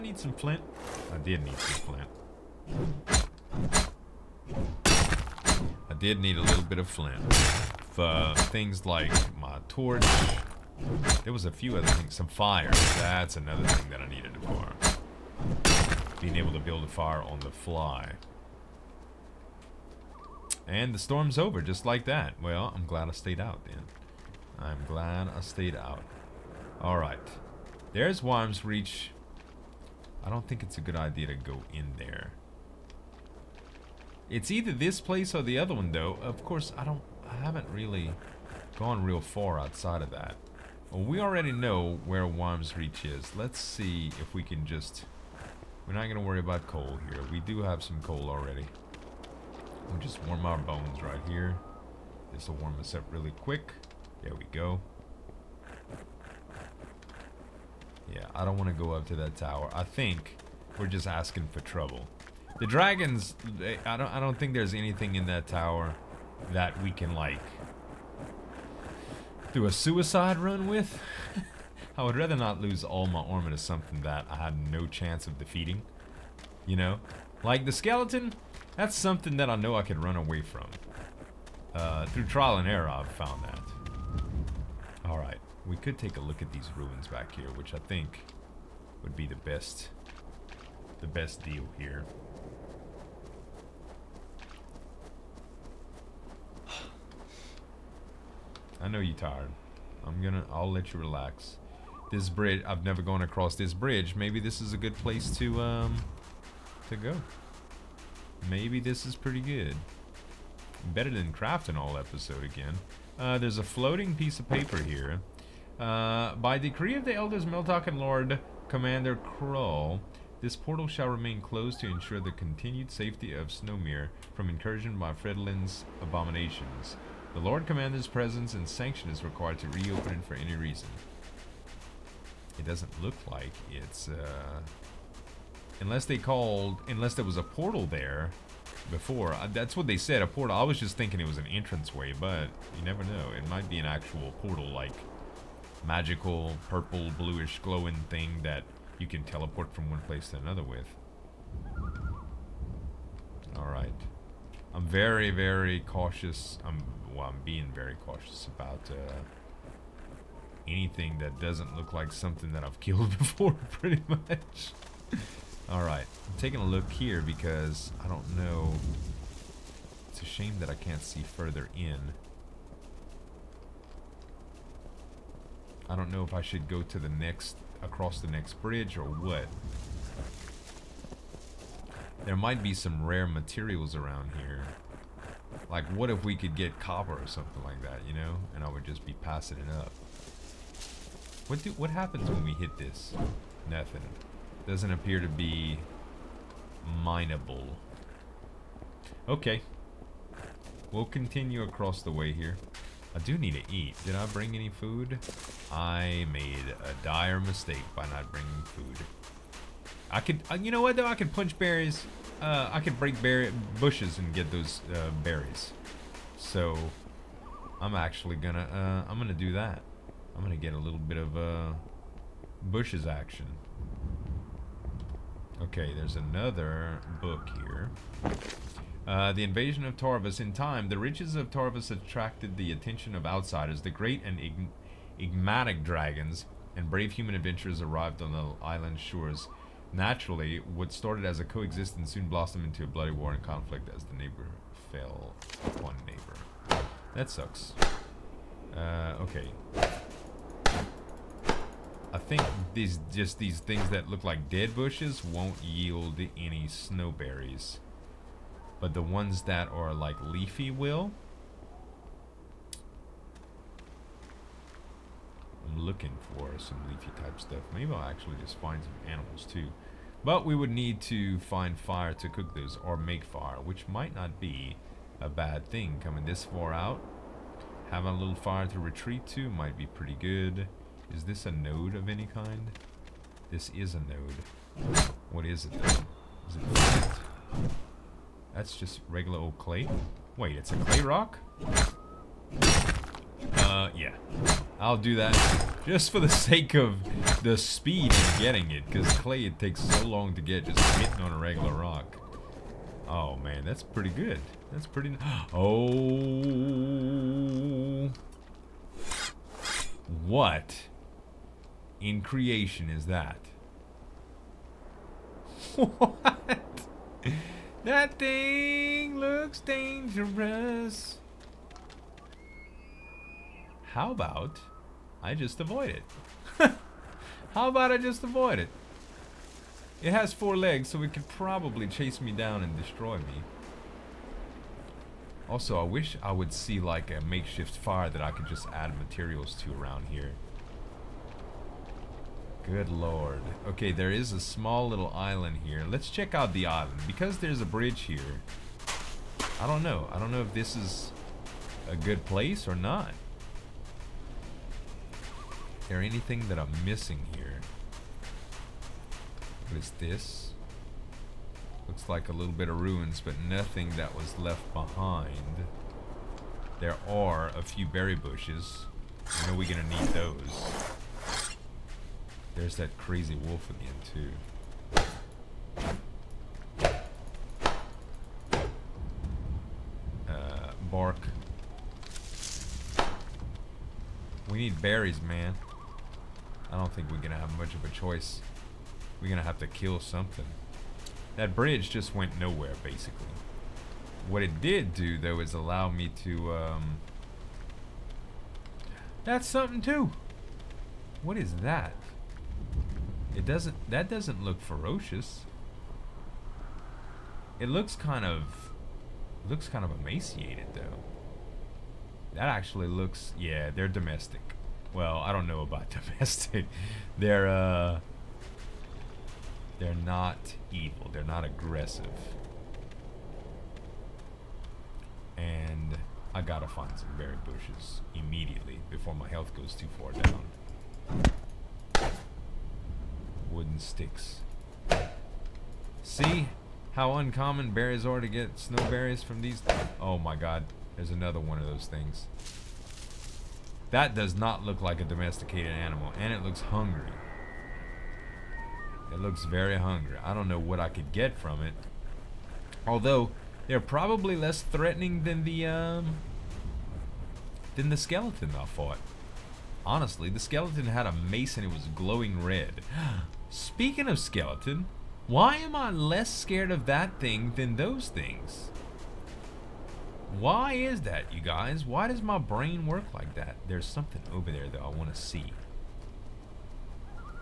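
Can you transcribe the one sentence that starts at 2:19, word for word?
Uh, that's what they said, a portal.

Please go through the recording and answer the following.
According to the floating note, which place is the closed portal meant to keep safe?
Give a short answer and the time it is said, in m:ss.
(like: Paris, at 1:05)
Snowmere, at 2:03.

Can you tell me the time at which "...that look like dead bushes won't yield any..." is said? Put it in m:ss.
4:13.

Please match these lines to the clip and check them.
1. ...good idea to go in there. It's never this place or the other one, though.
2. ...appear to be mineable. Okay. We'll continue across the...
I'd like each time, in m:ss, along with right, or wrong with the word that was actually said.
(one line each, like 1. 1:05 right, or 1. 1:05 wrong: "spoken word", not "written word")
1. 0:30 wrong: "either", not "never"
2. 3:14 right.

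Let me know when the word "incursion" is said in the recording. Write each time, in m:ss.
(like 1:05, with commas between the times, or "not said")
2:04.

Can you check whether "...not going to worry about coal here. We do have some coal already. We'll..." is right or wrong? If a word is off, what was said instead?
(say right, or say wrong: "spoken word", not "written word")
right.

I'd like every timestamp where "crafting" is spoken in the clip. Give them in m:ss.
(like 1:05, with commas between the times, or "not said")
1:51.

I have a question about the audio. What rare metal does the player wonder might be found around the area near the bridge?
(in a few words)
copper.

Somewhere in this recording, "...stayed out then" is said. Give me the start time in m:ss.
0:23.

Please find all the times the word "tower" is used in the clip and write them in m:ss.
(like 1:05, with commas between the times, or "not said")
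0:59, 1:05.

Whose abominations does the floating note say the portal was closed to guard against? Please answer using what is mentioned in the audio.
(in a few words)
Fredlin.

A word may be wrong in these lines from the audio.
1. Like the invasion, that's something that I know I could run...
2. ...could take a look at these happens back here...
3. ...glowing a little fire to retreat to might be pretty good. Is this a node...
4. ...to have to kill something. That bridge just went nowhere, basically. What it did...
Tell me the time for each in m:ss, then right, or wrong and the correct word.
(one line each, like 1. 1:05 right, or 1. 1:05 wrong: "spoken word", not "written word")
1. 1:17 wrong: "skeleton", not "invasion"
2. 1:25 wrong: "ruins", not "happens"
3. 4:37 wrong: "having", not "glowing"
4. 6:29 right.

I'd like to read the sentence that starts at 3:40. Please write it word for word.
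I'm gonna get a little bit of uh, bushes action.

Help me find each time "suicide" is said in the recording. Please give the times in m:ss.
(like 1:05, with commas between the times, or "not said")
1:09.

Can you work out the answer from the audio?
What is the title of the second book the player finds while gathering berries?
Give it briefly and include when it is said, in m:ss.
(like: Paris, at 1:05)
The Invasion of Tarvus, at 3:49.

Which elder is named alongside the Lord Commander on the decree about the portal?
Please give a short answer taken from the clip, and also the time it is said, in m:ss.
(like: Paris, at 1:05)
Meltok, at 1:57.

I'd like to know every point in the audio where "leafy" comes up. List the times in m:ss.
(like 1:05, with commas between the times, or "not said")
4:20, 4:26.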